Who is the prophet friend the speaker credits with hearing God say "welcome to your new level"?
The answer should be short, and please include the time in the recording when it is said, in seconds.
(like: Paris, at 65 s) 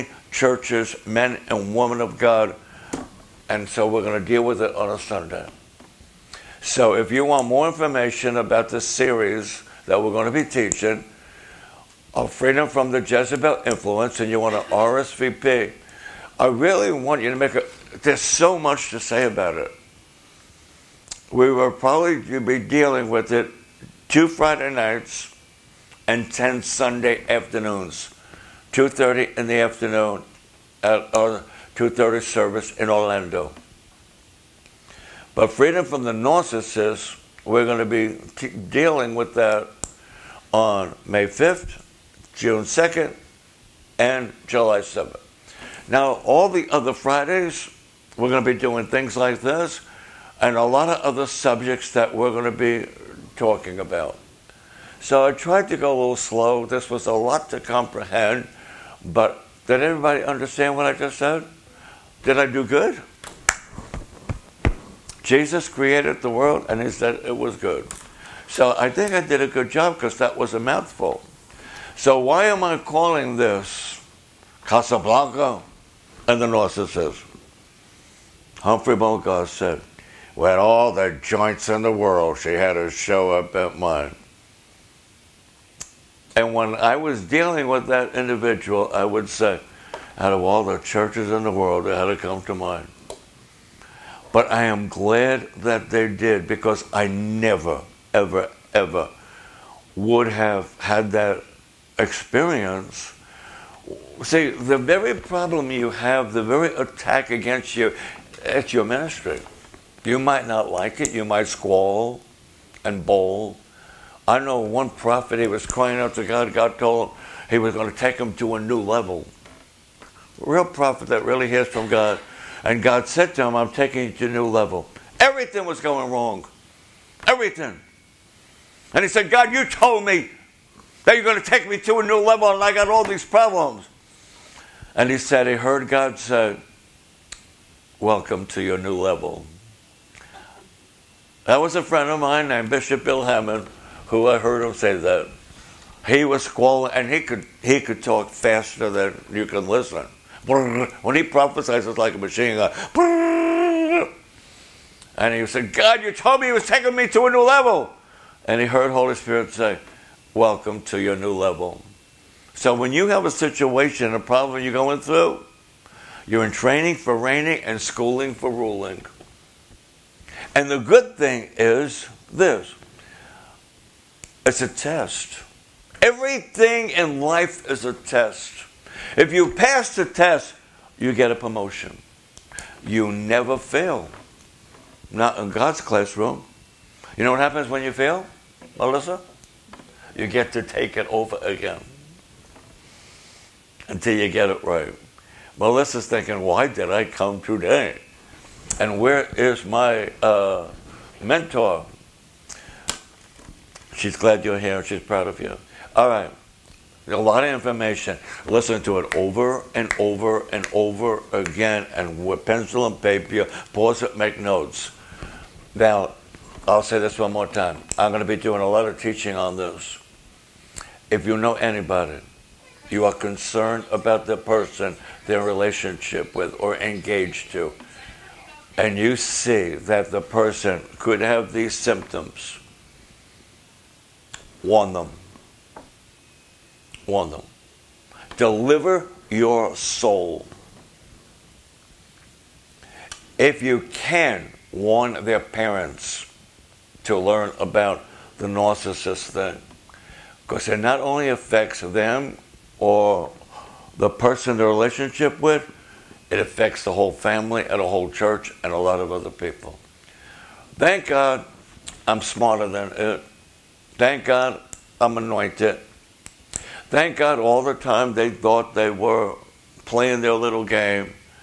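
Bishop Bill Hamon, at 142 s.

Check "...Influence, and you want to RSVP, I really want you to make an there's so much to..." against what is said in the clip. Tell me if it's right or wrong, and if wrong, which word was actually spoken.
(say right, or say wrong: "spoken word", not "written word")
right.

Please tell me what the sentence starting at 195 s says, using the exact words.
Melissa's thinking, why did I come today?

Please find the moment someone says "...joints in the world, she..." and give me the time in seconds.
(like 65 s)
81 s.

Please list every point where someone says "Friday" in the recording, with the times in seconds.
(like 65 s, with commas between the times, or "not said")
24 s, 46 s.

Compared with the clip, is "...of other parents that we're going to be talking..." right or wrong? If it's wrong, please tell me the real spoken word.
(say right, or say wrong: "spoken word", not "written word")
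wrong: "subjects", not "parents".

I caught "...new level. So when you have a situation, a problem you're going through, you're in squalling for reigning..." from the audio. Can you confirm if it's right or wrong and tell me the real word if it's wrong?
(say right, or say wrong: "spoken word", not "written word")
wrong: "training", not "squalling".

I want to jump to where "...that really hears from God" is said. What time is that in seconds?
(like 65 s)
121 s.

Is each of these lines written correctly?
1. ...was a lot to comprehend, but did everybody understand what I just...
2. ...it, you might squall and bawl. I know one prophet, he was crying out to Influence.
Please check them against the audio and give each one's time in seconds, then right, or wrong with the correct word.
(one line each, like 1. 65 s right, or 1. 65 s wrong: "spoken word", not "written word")
1. 56 s right
2. 110 s wrong: "God", not "Influence".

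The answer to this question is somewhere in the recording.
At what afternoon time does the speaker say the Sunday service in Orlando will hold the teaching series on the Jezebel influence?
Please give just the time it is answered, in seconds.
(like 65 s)
28 s.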